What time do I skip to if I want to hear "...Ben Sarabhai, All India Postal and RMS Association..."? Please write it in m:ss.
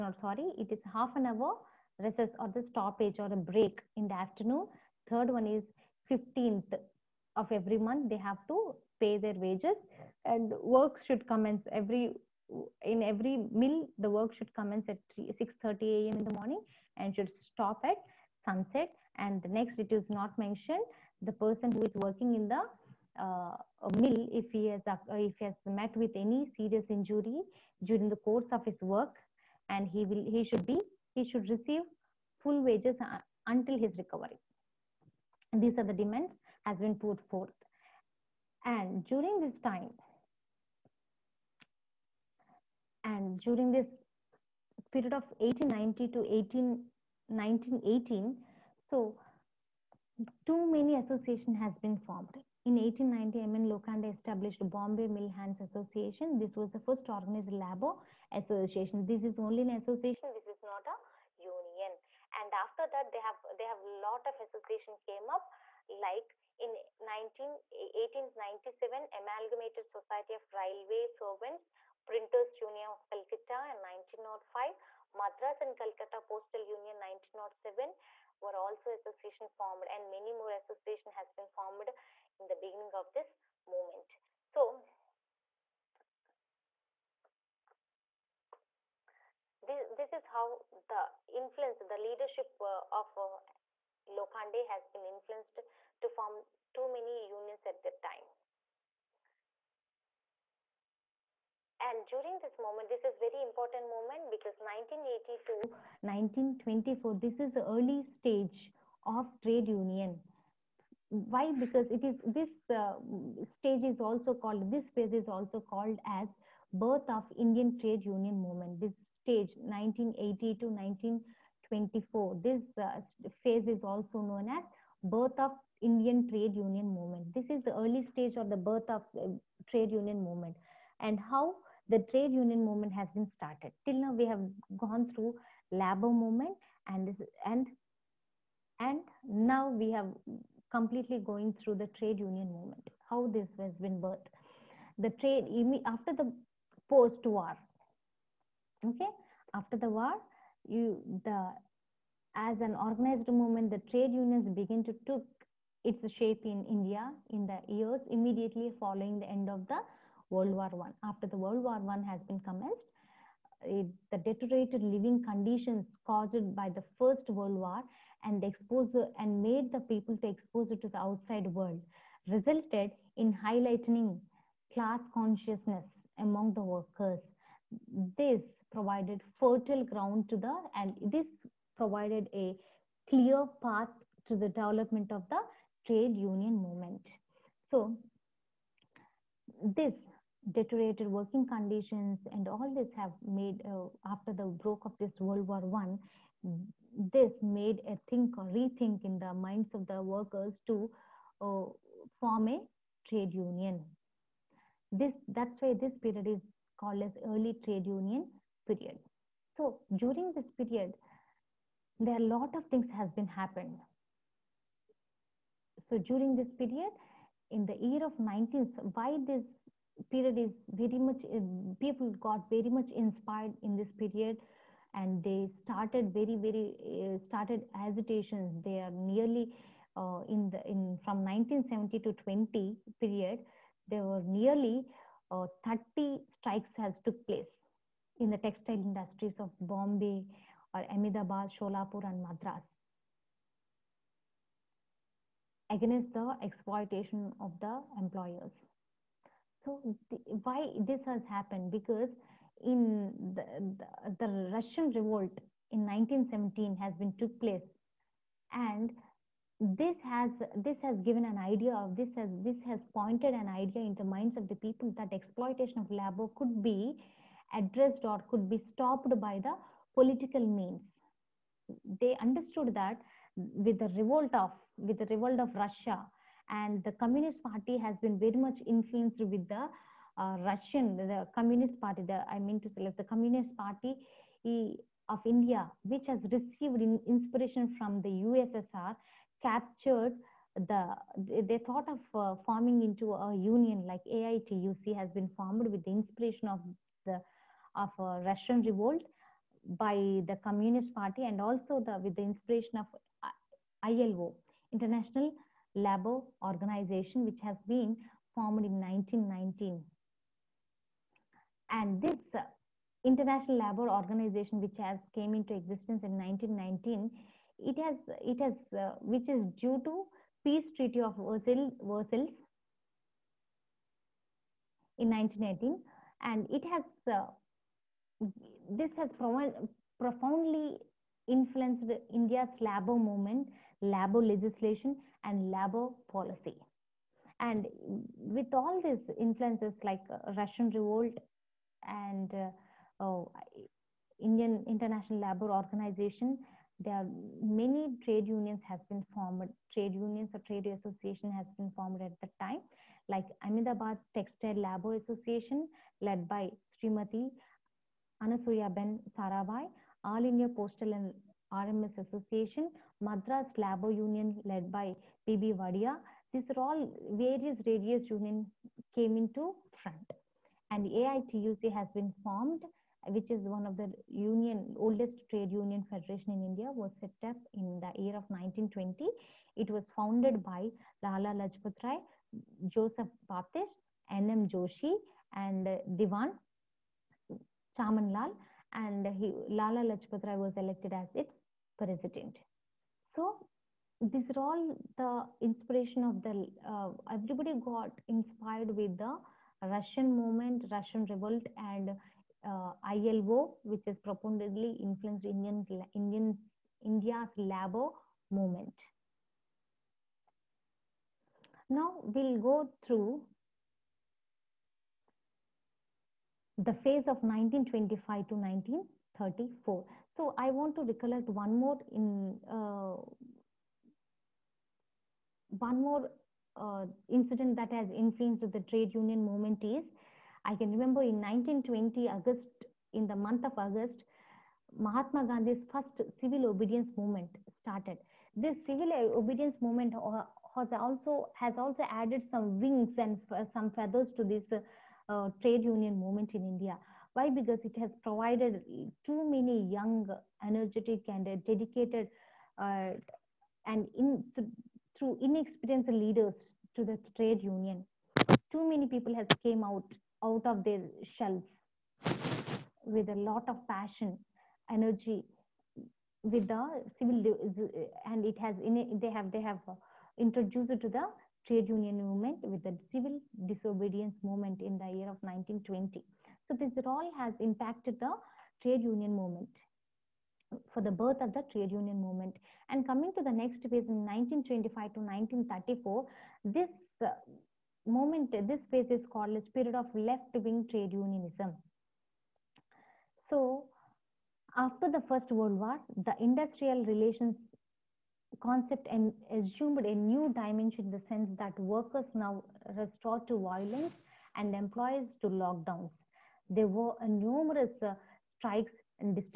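5:58.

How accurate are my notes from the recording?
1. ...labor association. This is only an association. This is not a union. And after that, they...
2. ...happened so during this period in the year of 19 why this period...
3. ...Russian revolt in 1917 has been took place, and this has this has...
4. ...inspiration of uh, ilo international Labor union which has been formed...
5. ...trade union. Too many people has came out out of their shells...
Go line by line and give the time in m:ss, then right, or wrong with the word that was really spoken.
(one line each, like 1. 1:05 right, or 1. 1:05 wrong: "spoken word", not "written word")
1. 0:57 right
2. 3:33 right
3. 4:14 right
4. 5:02 wrong: "organization", not "union"
5. 7:37 right.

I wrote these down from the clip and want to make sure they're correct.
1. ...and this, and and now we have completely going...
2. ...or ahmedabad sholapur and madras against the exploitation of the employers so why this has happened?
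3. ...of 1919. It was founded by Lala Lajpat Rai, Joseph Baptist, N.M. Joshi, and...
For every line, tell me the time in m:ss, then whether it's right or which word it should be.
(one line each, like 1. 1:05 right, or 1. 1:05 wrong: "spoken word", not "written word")
1. 2:16 right
2. 4:00 right
3. 6:18 wrong: "1920", not "1919".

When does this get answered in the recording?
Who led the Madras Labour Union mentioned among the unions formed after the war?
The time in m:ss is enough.
6:05.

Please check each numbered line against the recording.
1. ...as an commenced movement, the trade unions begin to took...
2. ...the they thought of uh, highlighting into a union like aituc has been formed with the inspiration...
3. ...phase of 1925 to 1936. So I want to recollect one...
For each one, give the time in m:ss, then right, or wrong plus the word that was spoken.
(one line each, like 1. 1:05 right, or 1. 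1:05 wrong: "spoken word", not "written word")
1. 2:32 wrong: "organized", not "commenced"
2. 4:50 wrong: "forming", not "highlighting"
3. 6:56 wrong: "1934", not "1936".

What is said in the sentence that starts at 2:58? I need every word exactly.
This provided fertile ground to the and this provided a clear path to the development of the trade union movement.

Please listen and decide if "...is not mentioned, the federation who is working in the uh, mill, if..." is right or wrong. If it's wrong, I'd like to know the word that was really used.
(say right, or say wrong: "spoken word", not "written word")
wrong: "person", not "federation".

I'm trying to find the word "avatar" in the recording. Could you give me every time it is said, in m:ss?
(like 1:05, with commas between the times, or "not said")
not said.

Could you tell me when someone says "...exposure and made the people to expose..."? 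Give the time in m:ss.
2:48.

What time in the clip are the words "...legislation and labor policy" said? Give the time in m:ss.
5:34.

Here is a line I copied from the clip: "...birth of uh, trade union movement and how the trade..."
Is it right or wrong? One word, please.
right.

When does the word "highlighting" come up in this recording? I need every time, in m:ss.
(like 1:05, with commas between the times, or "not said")
2:53.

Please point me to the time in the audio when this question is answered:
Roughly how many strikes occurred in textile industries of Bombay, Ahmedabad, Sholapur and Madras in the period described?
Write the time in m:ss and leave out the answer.
3:55.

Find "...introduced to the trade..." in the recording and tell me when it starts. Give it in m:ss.
7:50.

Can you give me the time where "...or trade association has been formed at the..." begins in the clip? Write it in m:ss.
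5:50.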